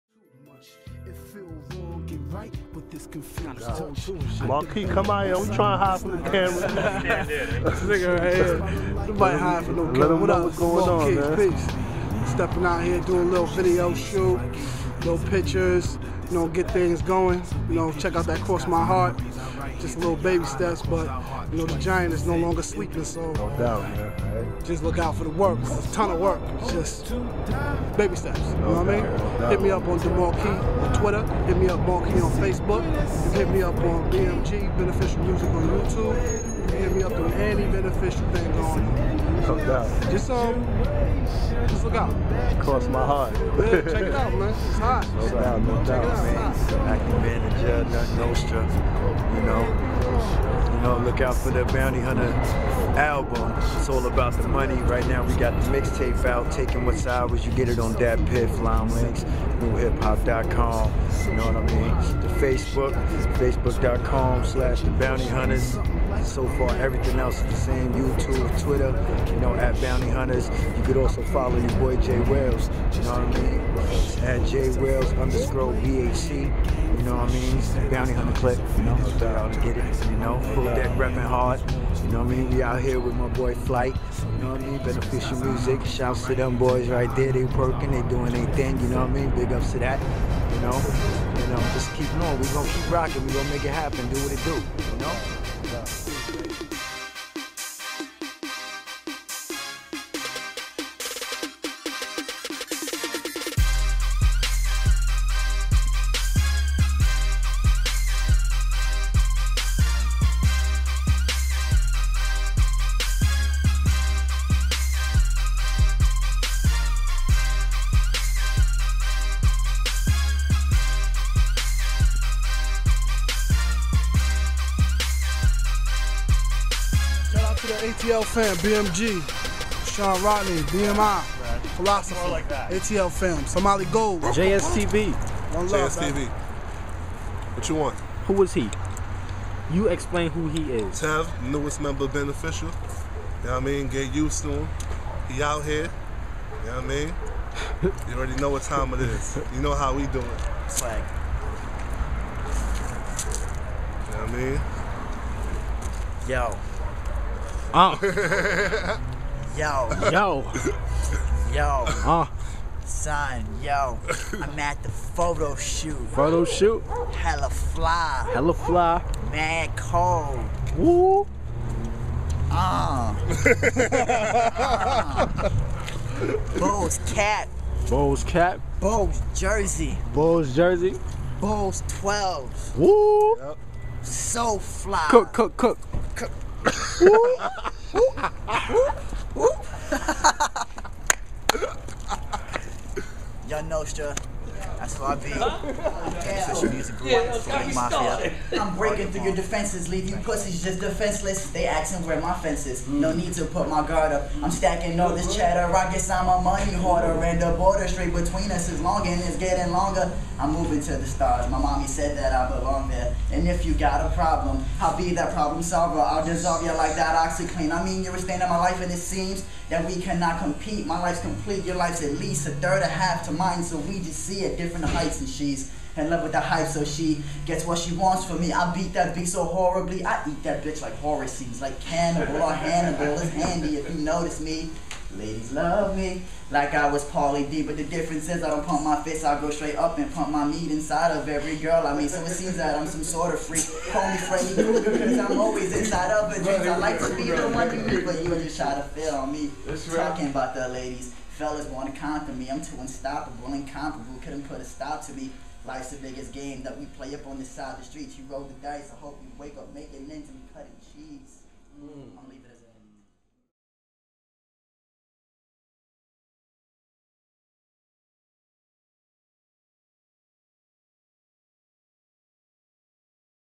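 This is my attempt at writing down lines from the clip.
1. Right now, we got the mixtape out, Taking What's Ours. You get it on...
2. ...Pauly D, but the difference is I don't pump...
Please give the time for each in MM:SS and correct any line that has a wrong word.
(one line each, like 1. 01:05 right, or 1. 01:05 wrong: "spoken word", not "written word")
1. 00:54 right
2. 03:57 right.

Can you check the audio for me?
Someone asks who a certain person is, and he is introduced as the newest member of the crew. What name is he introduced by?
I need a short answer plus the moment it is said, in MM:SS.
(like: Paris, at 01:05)
Tev, at 02:21.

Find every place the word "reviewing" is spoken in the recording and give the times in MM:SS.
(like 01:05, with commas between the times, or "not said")
not said.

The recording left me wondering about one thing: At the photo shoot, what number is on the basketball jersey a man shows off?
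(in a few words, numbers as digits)
12.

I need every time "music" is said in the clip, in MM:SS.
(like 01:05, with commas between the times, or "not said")
00:35, 01:25, 03:16.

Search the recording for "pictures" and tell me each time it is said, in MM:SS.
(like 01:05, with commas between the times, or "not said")
00:15.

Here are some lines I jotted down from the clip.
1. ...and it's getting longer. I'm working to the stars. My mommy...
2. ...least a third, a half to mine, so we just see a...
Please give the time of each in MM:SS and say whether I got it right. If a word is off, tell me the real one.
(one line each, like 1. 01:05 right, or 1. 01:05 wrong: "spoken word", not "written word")
1. 03:29 wrong: "moving", not "working"
2. 03:42 right.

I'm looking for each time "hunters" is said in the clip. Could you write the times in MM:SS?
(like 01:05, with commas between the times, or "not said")
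00:52, 01:05, 01:10, 01:18.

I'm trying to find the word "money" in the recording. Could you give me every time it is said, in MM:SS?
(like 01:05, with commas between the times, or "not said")
00:54, 03:26.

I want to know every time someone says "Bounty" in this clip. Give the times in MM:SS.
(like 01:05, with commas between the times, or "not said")
00:51, 01:04, 01:09, 01:17.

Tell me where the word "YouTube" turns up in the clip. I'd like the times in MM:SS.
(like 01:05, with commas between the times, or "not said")
00:35, 01:07.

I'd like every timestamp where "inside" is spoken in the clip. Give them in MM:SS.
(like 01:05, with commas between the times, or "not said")
04:00, 04:05.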